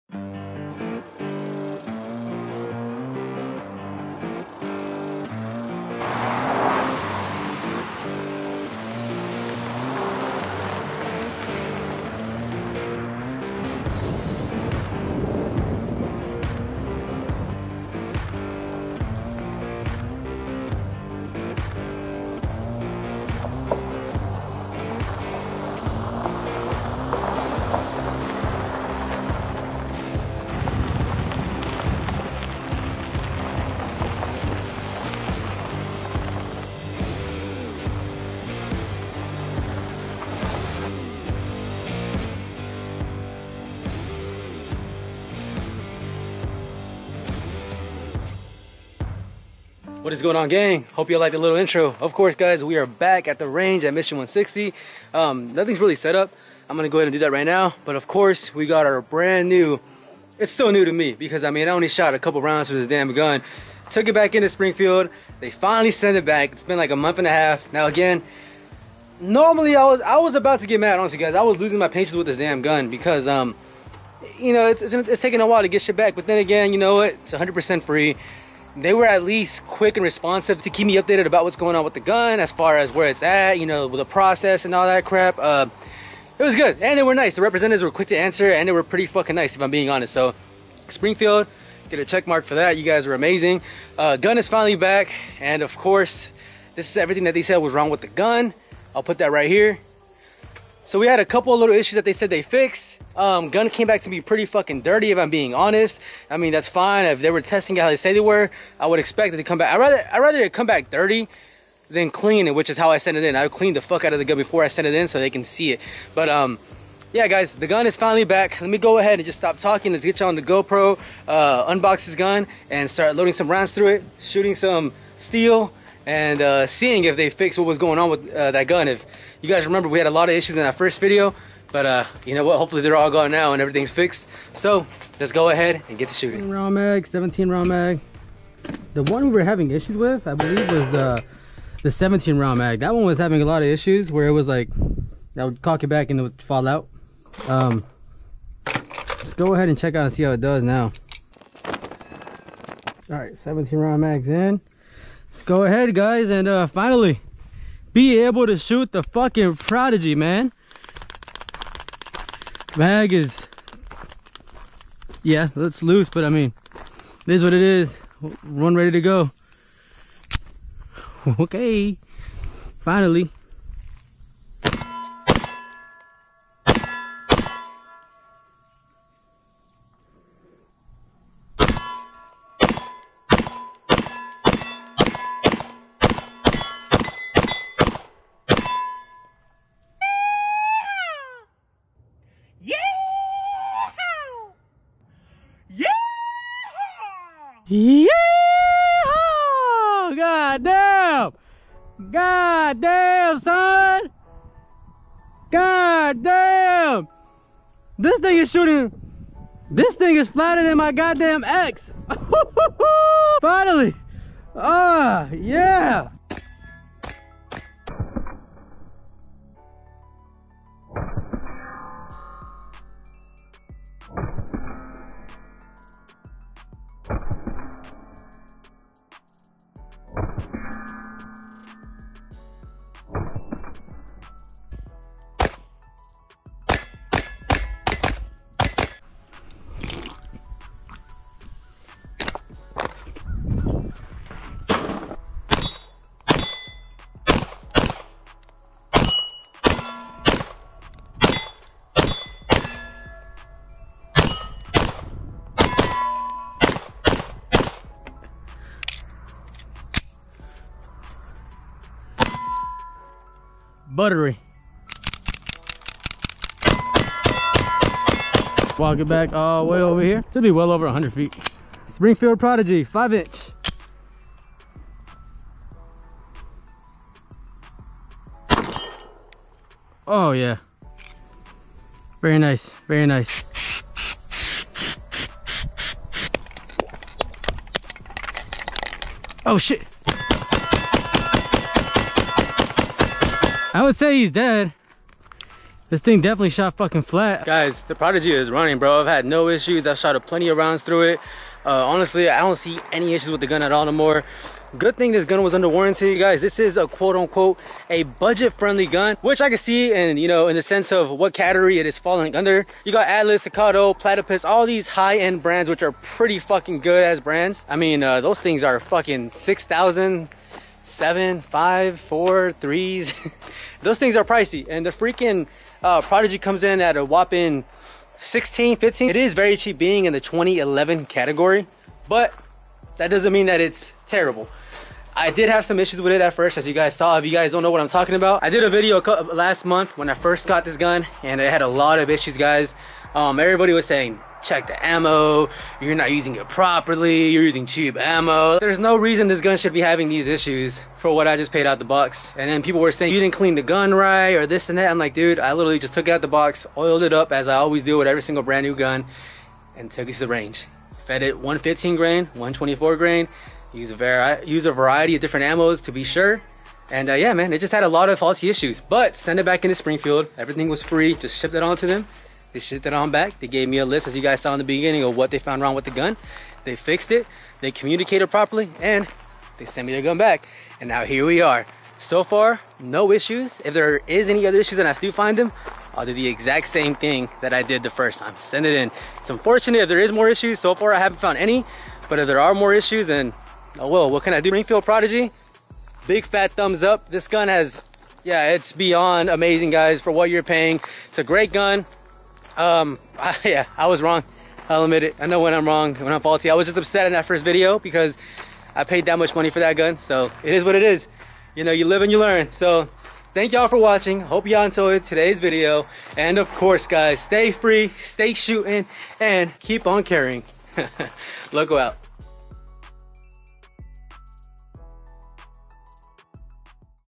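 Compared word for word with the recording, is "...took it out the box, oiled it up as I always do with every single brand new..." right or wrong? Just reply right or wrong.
right.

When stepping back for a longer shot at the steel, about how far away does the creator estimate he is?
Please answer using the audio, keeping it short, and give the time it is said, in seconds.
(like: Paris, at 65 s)
over 100 feet, at 270 s.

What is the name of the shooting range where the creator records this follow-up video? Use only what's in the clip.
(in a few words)
Mission 160.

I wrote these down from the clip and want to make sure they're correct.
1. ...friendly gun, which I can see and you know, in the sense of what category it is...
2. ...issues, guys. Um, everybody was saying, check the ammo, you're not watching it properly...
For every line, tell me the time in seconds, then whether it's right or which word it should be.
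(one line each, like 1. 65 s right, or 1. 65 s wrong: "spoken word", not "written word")
1. 308 s right
2. 342 s wrong: "using", not "watching".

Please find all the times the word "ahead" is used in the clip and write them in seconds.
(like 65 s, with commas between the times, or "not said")
56 s, 118 s, 135 s, 149 s, 155 s.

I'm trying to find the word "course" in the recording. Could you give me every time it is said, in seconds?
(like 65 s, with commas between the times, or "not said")
52 s, 58 s, 95 s, 416 s.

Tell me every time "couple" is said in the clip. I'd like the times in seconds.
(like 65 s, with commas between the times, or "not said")
62 s, 101 s.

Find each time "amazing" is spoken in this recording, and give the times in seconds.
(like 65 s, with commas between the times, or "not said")
93 s, 399 s.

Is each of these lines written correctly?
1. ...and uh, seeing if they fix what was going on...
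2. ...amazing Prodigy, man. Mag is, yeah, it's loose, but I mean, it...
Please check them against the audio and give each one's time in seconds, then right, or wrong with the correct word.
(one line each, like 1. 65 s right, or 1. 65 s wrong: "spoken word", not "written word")
1. 126 s right
2. 159 s wrong: "fucking", not "amazing".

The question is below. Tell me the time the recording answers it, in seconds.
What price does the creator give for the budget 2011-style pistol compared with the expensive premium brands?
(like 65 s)
328 s.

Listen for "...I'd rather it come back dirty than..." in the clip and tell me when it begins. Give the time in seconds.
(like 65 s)
110 s.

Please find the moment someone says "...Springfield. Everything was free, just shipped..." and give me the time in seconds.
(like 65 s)
369 s.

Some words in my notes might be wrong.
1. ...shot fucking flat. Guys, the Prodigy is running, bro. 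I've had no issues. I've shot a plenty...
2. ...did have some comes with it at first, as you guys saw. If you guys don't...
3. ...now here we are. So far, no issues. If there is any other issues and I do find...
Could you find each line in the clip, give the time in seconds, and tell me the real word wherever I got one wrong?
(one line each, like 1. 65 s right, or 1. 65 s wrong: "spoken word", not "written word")
1. 296 s right
2. 335 s wrong: "issues", not "comes"
3. 380 s right.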